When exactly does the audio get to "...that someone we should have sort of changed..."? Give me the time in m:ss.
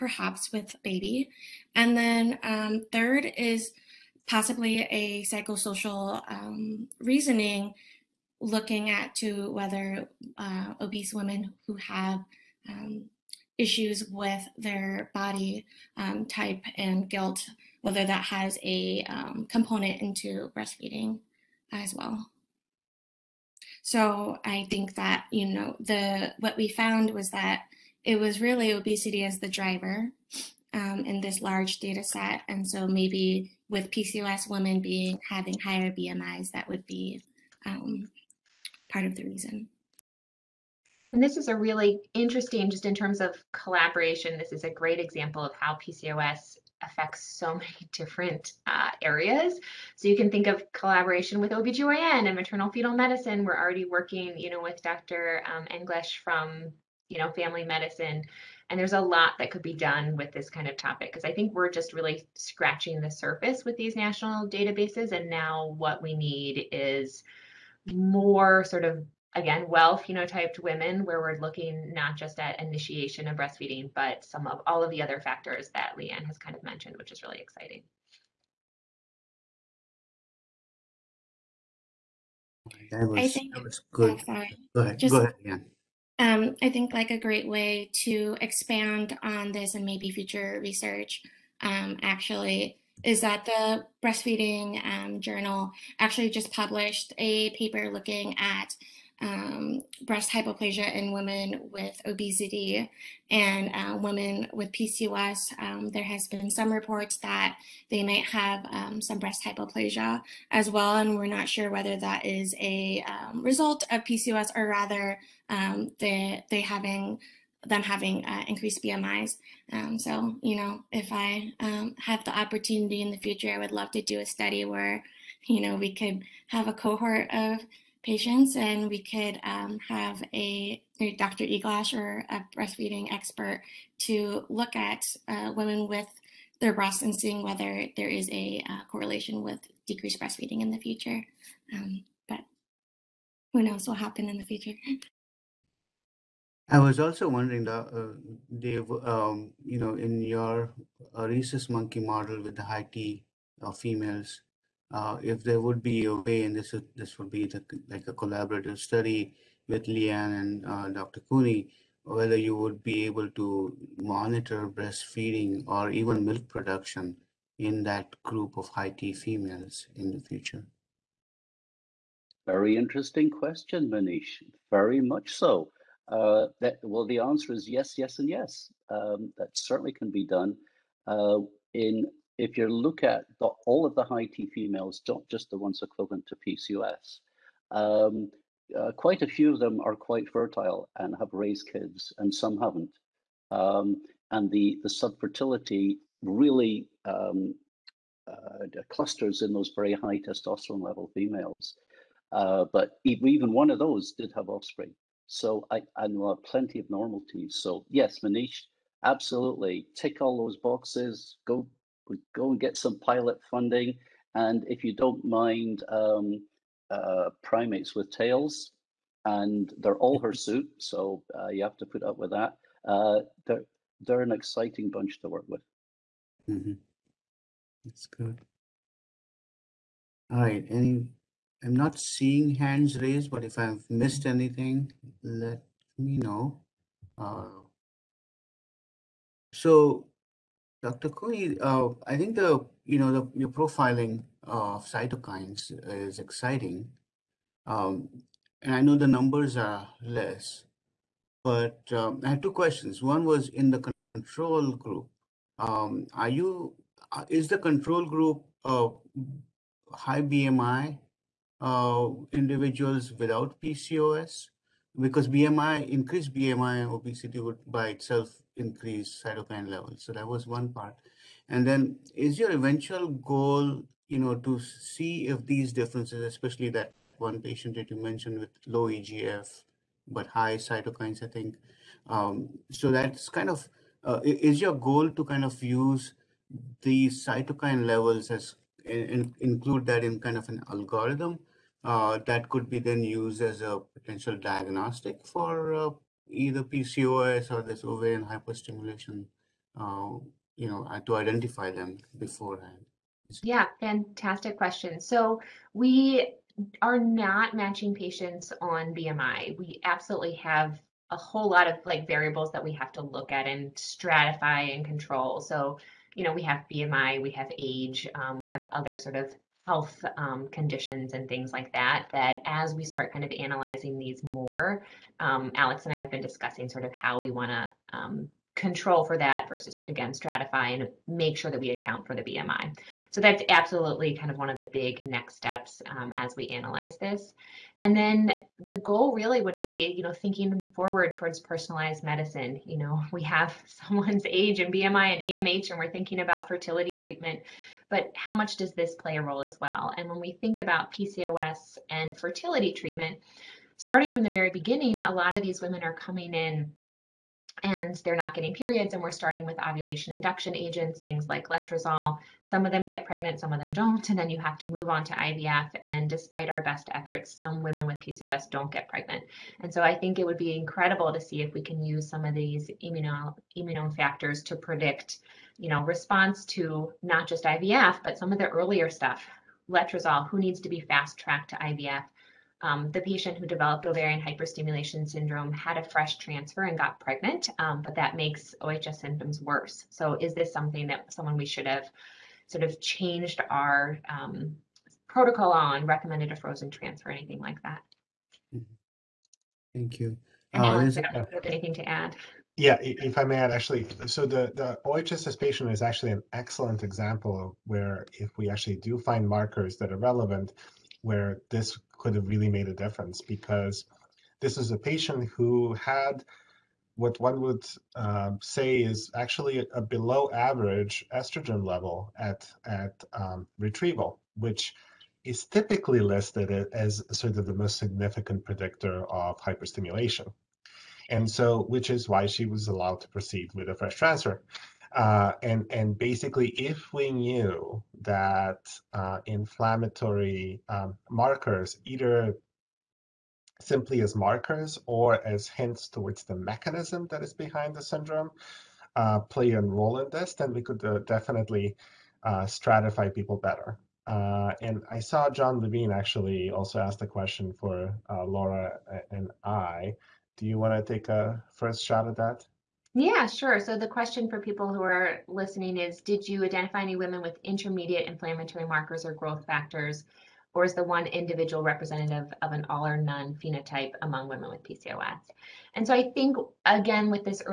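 6:30.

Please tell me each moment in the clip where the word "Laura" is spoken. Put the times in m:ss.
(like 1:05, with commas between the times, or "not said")
7:38.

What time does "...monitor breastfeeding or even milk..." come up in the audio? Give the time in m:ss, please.
2:44.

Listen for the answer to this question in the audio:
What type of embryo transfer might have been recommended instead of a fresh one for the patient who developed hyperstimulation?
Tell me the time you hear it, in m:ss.
6:36.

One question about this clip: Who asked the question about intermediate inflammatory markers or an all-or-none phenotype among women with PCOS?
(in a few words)
John Levine.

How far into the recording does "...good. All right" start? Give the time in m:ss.
3:48.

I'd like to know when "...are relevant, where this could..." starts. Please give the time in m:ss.
6:49.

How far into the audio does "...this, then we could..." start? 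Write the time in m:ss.
7:30.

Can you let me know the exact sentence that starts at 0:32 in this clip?
And so maybe with PCOS women being having higher BMIs, that would be um, part of the reason.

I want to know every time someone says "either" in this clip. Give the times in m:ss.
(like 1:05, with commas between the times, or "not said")
4:56, 7:21.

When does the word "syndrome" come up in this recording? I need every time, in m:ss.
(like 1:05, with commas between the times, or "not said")
6:25, 7:27.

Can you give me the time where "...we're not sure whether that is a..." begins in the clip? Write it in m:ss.
1:51.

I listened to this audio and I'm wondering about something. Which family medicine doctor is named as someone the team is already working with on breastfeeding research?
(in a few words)
Dr. Eglash.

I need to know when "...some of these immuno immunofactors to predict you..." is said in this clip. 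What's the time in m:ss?
6:12.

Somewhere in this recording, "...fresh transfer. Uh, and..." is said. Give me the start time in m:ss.
7:13.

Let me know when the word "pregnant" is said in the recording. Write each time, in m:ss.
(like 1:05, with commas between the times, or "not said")
6:03, 6:08, 6:27.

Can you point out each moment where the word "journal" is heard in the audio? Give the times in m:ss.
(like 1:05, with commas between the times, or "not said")
1:35.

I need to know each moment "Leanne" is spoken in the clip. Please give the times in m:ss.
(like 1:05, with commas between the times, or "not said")
1:15, 2:39.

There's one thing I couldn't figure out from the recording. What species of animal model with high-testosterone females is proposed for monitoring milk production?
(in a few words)
Rhesus monkey.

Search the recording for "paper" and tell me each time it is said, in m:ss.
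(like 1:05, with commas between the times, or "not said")
1:37.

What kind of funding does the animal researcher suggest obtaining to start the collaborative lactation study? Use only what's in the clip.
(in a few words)
Pilot funding.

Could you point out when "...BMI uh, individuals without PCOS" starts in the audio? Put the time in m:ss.
4:20.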